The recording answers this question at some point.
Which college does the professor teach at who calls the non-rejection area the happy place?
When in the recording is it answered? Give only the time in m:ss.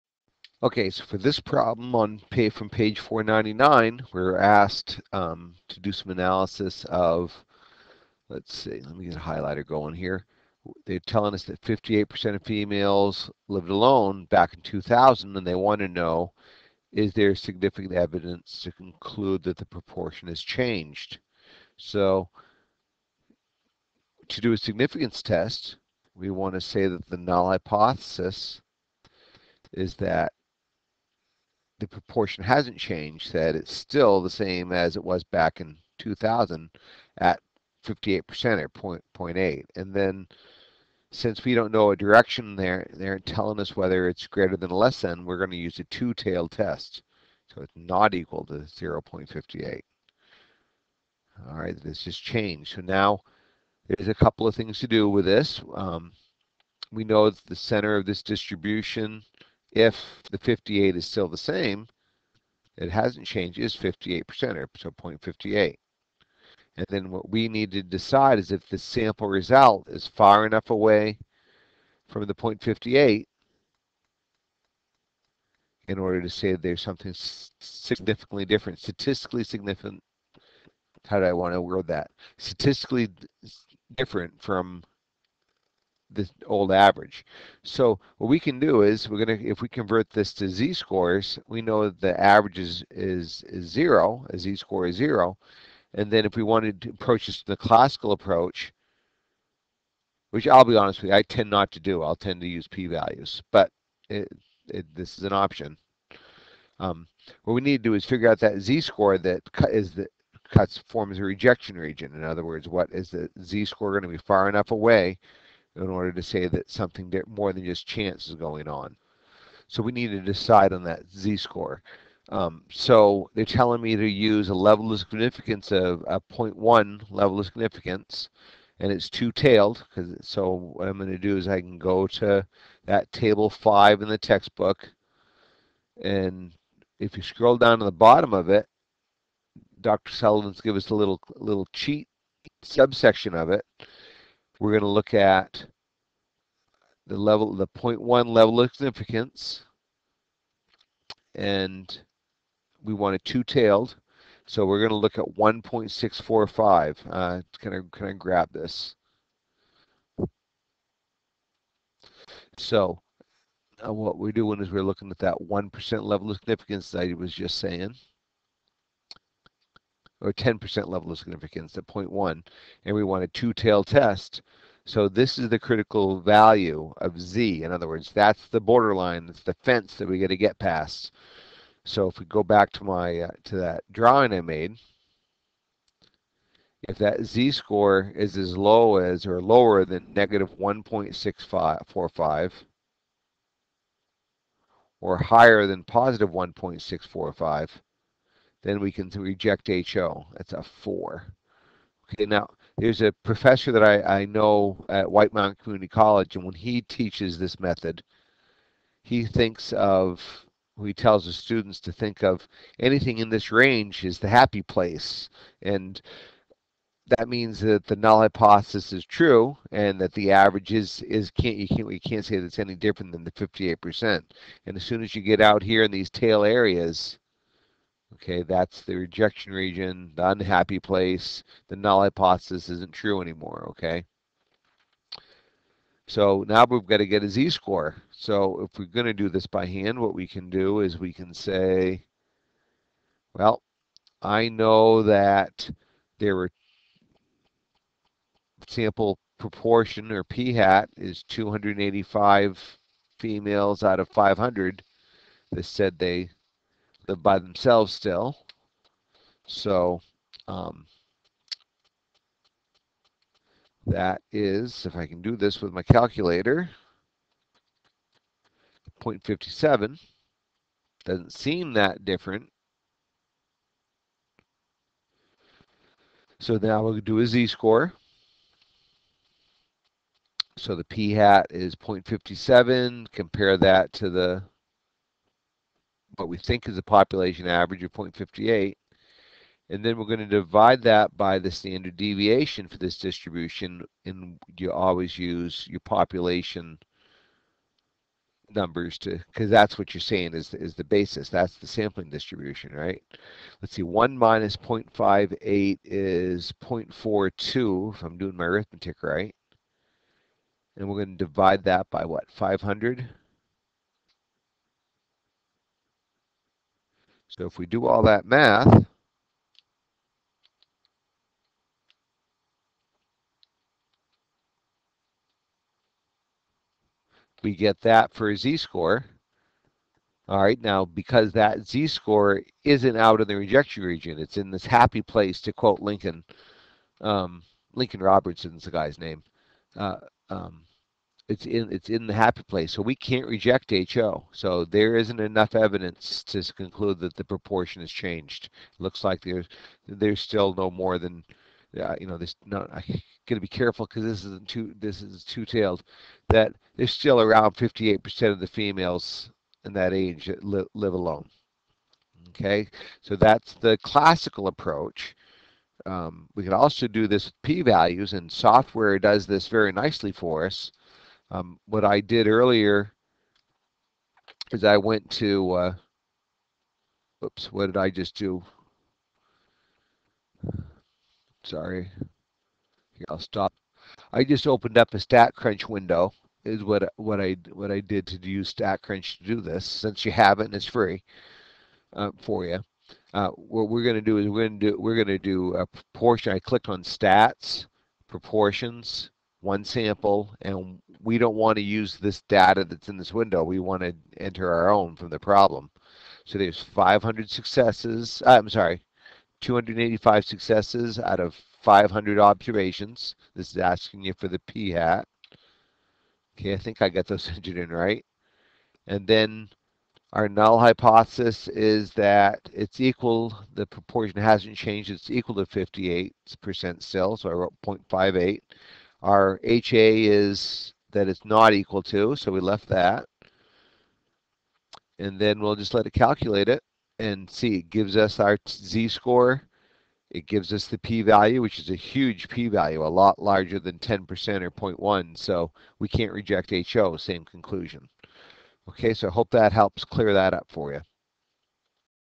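3:25.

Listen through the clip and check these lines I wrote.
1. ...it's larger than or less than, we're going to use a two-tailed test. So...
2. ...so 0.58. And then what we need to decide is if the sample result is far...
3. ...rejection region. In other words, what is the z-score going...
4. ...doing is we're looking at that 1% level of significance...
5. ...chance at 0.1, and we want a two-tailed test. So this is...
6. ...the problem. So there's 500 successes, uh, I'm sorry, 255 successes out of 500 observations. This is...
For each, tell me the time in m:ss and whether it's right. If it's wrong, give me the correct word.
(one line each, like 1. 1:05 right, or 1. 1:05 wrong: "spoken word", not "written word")
1. 0:44 wrong: "greater", not "larger"
2. 1:04 right
3. 1:51 right
4. 2:44 right
5. 2:51 wrong: "significance", not "chance"
6. 6:45 wrong: "285", not "255".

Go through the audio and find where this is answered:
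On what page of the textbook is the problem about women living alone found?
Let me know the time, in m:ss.
0:02.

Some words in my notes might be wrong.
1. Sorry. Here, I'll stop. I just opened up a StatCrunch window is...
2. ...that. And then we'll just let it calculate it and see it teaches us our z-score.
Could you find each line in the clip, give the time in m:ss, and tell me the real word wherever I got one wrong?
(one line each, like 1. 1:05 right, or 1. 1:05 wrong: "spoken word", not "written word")
1. 6:21 right
2. 7:12 wrong: "gives", not "teaches".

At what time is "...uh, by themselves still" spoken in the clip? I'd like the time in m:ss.
4:17.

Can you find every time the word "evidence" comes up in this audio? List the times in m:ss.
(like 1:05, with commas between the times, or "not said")
0:17, 5:45.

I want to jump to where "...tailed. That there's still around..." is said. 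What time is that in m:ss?
5:55.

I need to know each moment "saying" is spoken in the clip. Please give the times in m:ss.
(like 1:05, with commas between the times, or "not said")
2:47, 5:00.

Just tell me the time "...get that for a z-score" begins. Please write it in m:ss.
5:27.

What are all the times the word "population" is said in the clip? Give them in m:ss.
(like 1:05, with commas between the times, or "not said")
4:46, 4:55.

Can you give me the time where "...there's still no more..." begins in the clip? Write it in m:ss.
5:49.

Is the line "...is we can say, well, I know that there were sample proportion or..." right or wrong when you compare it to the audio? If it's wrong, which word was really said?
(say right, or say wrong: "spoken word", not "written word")
right.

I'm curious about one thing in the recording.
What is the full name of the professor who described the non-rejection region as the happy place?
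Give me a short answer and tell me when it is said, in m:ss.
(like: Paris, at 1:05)
Lincoln Robertson, at 5:37.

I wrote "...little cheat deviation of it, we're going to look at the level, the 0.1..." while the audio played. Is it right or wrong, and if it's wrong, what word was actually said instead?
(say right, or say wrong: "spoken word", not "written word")
wrong: "subsection", not "deviation".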